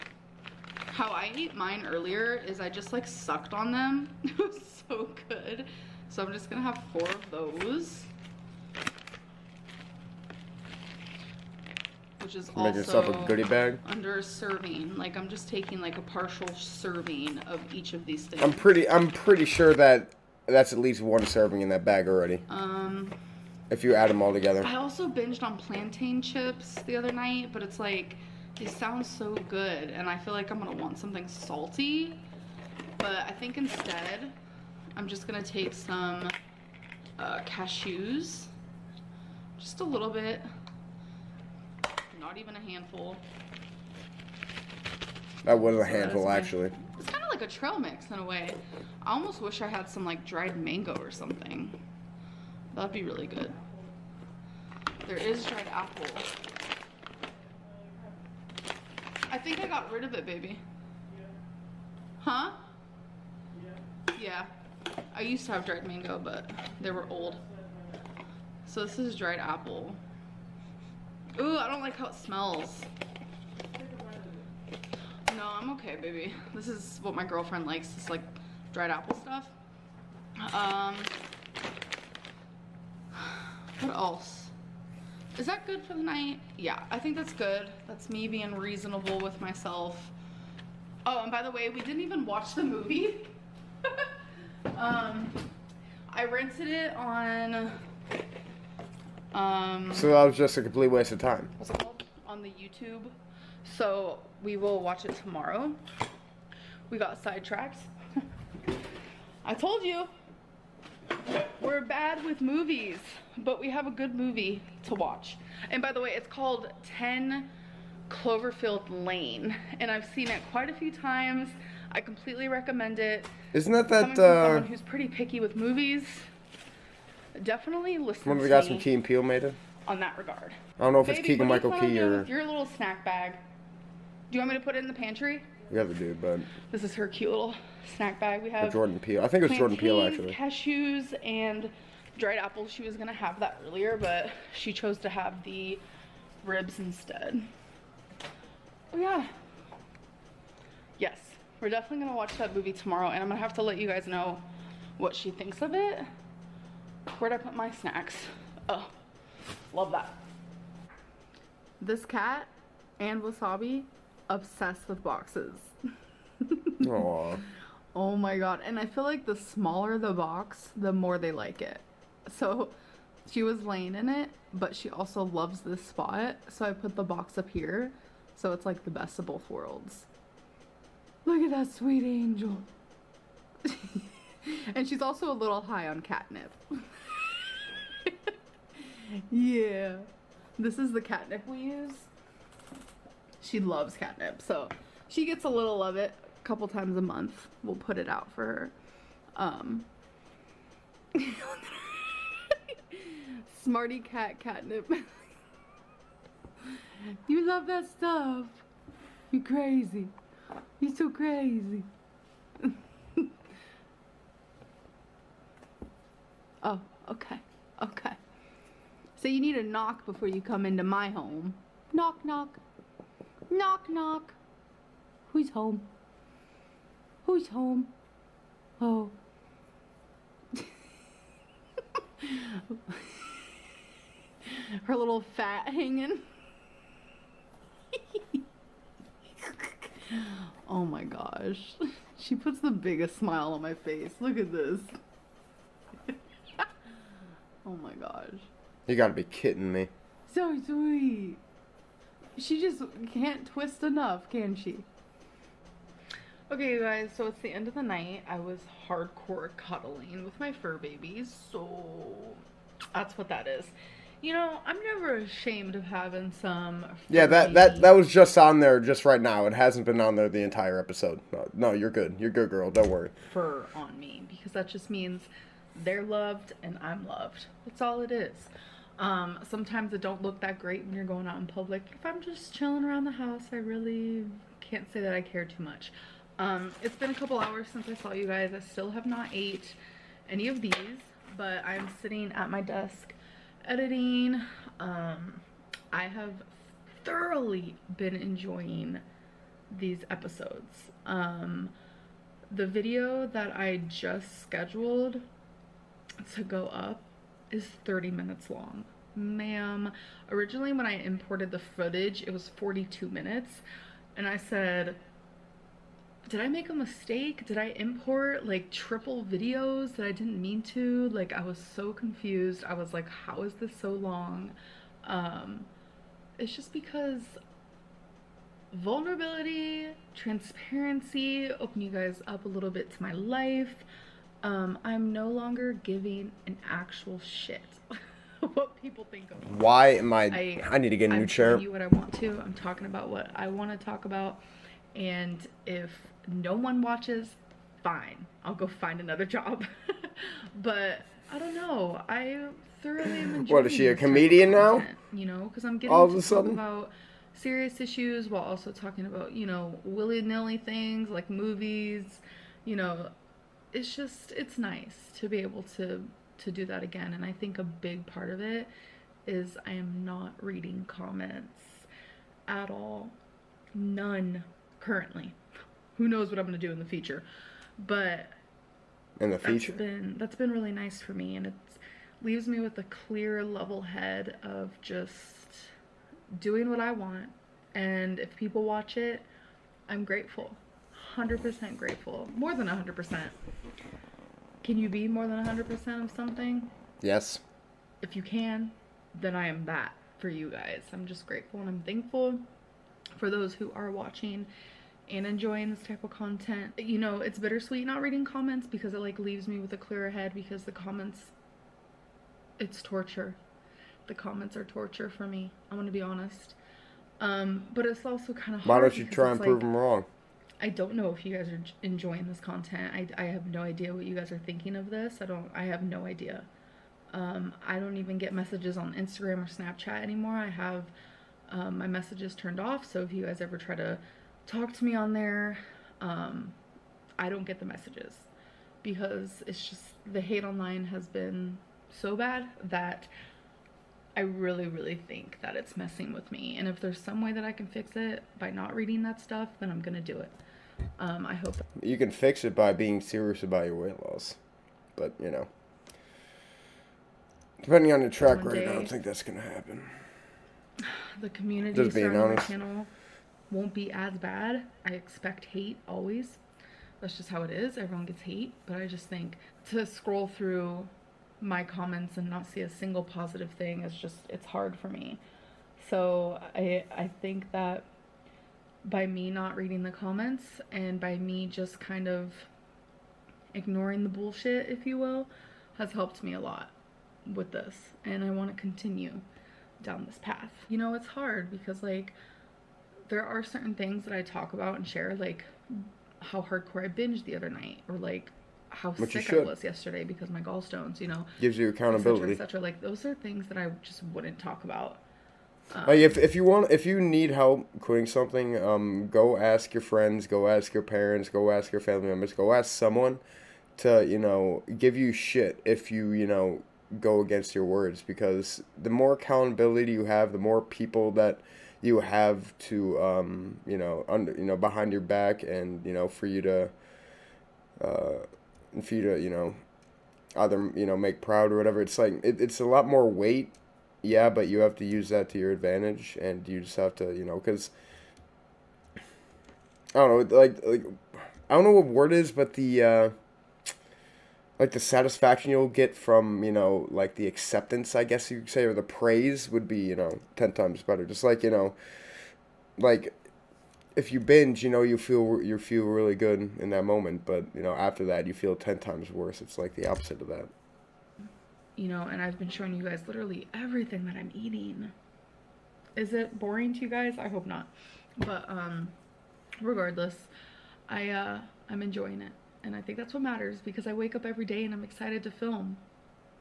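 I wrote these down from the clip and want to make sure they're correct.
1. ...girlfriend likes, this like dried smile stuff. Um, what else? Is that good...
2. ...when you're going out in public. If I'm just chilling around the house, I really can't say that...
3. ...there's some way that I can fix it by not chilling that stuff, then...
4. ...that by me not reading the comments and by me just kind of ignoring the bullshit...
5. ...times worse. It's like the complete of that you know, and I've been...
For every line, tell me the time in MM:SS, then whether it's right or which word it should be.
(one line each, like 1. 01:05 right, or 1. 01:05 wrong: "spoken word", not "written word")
1. 01:17 wrong: "apple", not "smile"
2. 04:40 right
3. 07:26 wrong: "reading", not "chilling"
4. 07:57 right
5. 09:18 wrong: "opposite", not "complete".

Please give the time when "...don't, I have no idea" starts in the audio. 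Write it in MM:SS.
07:05.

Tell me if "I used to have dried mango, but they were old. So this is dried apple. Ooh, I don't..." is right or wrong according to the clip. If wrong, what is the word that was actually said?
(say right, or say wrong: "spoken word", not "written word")
right.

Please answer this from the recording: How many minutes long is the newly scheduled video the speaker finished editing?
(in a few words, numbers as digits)
30 minutes.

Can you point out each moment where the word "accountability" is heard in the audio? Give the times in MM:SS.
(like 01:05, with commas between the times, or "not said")
08:21, 08:39.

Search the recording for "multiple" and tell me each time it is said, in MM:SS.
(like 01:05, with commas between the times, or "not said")
not said.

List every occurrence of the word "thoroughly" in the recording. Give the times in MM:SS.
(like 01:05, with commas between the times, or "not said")
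04:57, 05:52.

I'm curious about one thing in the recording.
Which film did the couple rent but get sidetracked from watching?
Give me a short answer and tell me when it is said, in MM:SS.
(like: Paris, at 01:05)
10 Cloverfield Lane, at 01:56.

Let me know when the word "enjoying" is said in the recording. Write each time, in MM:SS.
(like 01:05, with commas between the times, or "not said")
04:58, 05:53, 06:45, 07:01, 09:31.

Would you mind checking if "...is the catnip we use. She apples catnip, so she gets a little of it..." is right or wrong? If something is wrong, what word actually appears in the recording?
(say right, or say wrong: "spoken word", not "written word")
wrong: "loves", not "apples".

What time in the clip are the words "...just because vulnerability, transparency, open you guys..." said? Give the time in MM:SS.
05:26.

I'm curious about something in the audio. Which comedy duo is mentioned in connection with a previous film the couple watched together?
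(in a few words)
Key and Peele.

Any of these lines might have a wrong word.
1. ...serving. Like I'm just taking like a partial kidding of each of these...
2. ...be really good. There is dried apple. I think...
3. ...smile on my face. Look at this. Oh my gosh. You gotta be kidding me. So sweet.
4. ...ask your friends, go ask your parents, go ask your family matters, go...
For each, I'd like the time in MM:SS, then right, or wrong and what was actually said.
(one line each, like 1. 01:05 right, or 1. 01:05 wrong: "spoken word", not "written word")
1. 00:14 wrong: "serving", not "kidding"
2. 00:52 right
3. 04:03 right
4. 08:29 wrong: "members", not "matters".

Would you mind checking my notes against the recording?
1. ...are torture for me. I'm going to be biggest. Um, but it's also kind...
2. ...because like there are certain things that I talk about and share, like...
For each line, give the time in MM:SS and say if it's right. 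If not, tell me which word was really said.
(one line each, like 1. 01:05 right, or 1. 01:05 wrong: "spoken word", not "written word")
1. 06:54 wrong: "honest", not "biggest"
2. 08:11 right.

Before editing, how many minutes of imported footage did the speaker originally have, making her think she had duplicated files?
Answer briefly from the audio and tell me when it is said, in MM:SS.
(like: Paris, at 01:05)
42 minutes, at 05:12.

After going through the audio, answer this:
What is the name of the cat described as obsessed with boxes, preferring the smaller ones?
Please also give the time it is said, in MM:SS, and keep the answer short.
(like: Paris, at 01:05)
Wasabi, at 02:43.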